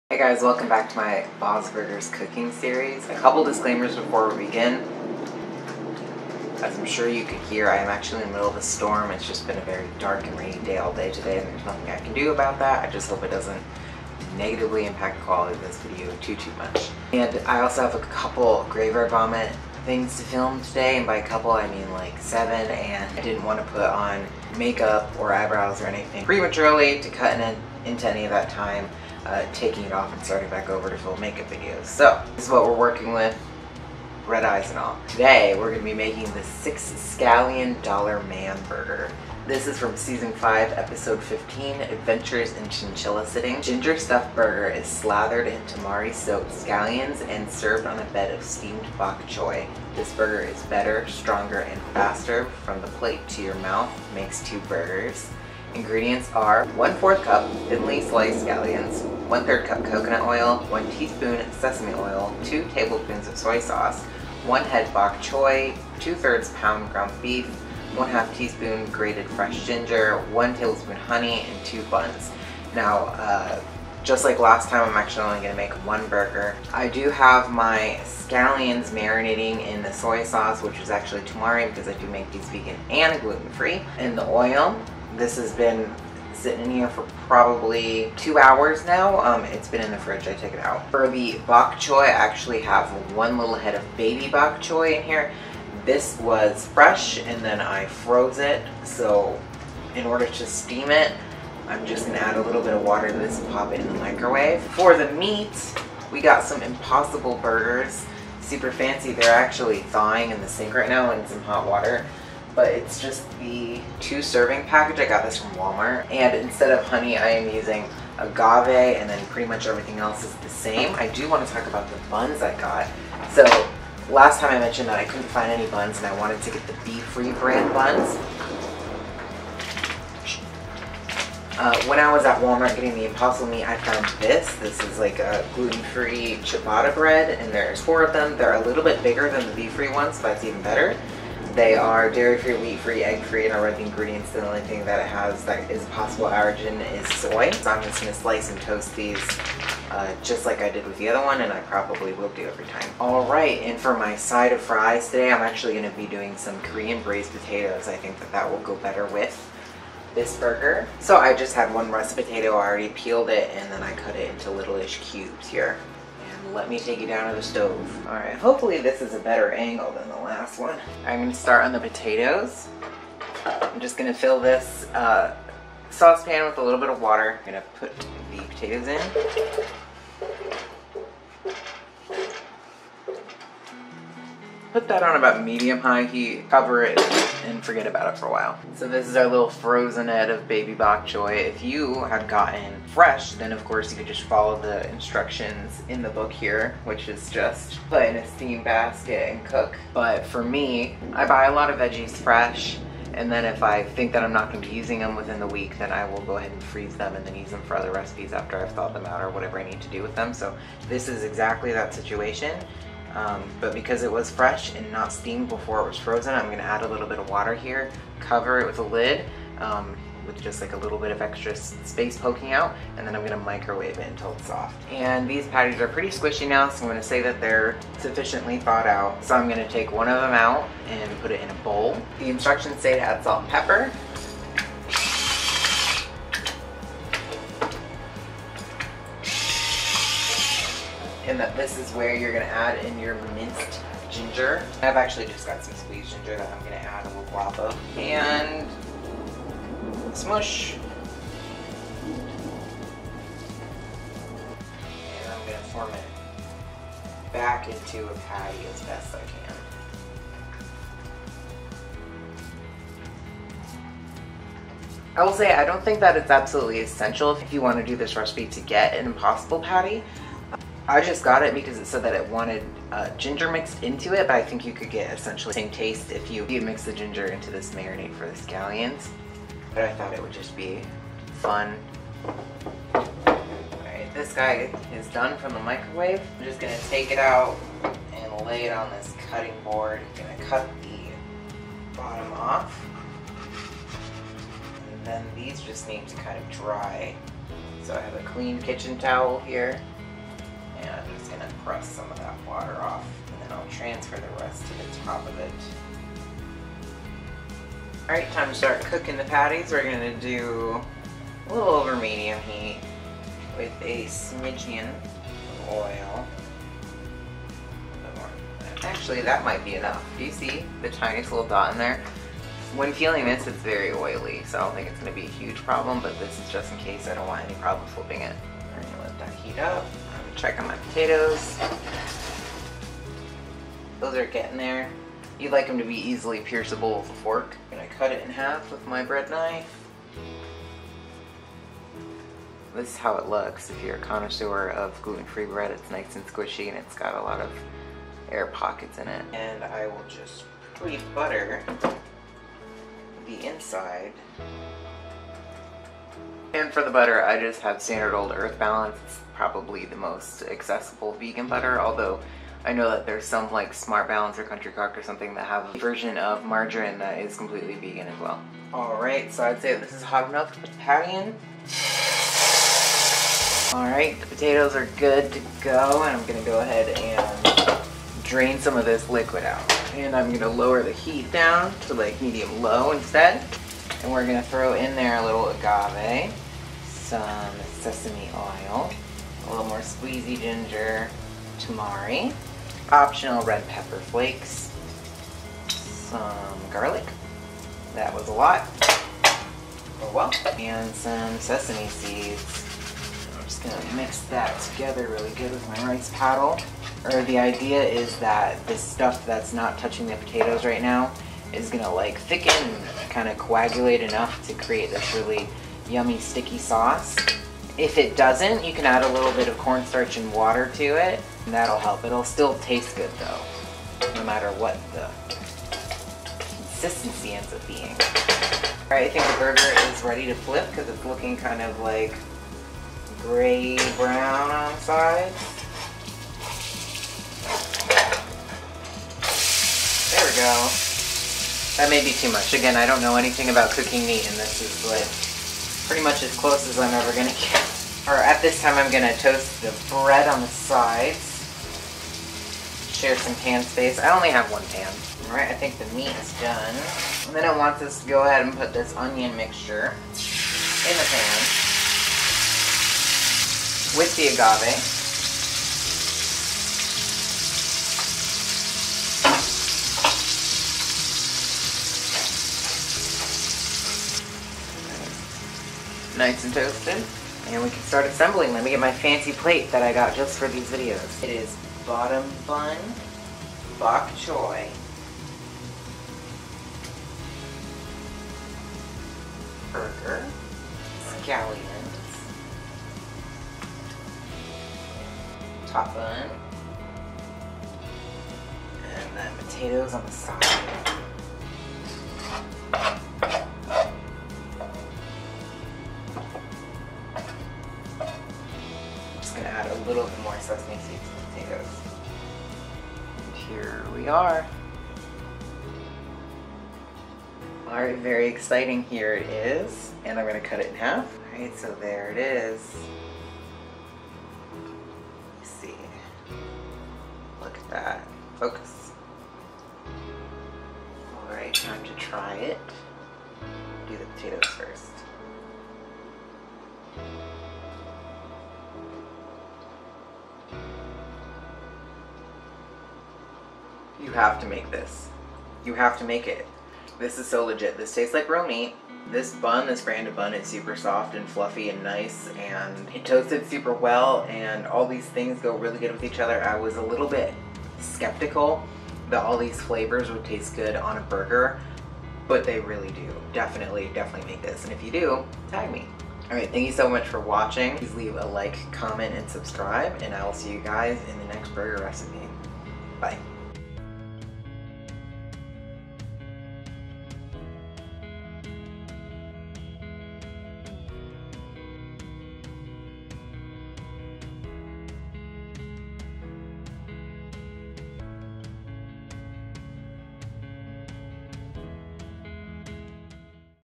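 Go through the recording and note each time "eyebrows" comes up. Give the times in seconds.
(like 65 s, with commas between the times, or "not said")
25 s.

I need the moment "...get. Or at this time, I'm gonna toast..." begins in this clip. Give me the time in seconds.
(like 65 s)
447 s.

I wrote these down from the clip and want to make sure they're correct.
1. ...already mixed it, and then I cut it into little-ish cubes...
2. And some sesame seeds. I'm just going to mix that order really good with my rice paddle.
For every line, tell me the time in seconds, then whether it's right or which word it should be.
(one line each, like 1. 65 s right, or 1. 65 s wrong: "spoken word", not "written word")
1. 162 s wrong: "peeled", not "mixed"
2. 400 s wrong: "together", not "order".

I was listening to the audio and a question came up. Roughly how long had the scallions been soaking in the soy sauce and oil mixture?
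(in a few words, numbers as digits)
2 hours.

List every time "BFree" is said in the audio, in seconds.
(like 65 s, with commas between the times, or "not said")
126 s, 139 s.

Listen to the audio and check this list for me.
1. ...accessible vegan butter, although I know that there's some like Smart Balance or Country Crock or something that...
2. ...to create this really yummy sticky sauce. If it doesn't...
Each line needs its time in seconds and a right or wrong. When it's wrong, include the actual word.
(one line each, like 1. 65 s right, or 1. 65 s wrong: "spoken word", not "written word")
1. 360 s right
2. 414 s right.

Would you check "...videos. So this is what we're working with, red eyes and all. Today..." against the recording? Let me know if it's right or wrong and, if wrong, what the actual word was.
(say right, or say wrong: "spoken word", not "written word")
right.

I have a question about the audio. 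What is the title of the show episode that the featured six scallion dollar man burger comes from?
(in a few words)
Adventures in Chinchilla Sitting.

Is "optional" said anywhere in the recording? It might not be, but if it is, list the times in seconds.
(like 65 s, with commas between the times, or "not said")
392 s.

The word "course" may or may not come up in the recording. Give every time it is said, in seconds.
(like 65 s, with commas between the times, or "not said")
193 s.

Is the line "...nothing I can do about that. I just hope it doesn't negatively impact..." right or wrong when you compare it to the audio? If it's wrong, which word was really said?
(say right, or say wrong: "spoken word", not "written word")
right.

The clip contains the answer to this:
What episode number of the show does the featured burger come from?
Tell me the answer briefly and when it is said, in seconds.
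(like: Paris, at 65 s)
15, at 40 s.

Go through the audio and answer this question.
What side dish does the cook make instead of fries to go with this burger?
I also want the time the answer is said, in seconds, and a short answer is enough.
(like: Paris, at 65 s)
Korean braised potatoes, at 156 s.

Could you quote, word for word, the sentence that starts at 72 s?
Now, uh, just like last time, I'm actually only going to make one burger.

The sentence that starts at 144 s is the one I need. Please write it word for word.
The only thing that it has that is possible allergen is soy.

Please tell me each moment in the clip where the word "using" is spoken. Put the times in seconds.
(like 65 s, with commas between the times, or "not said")
117 s, 204 s.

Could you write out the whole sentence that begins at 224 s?
And these patties are pretty squishy now, so I'm gonna say that they're sufficiently thawed out.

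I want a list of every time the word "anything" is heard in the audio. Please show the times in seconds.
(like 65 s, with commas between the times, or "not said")
25 s, 443 s.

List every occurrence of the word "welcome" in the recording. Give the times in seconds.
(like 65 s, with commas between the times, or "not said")
0 s.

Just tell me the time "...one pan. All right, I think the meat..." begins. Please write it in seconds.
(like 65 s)
454 s.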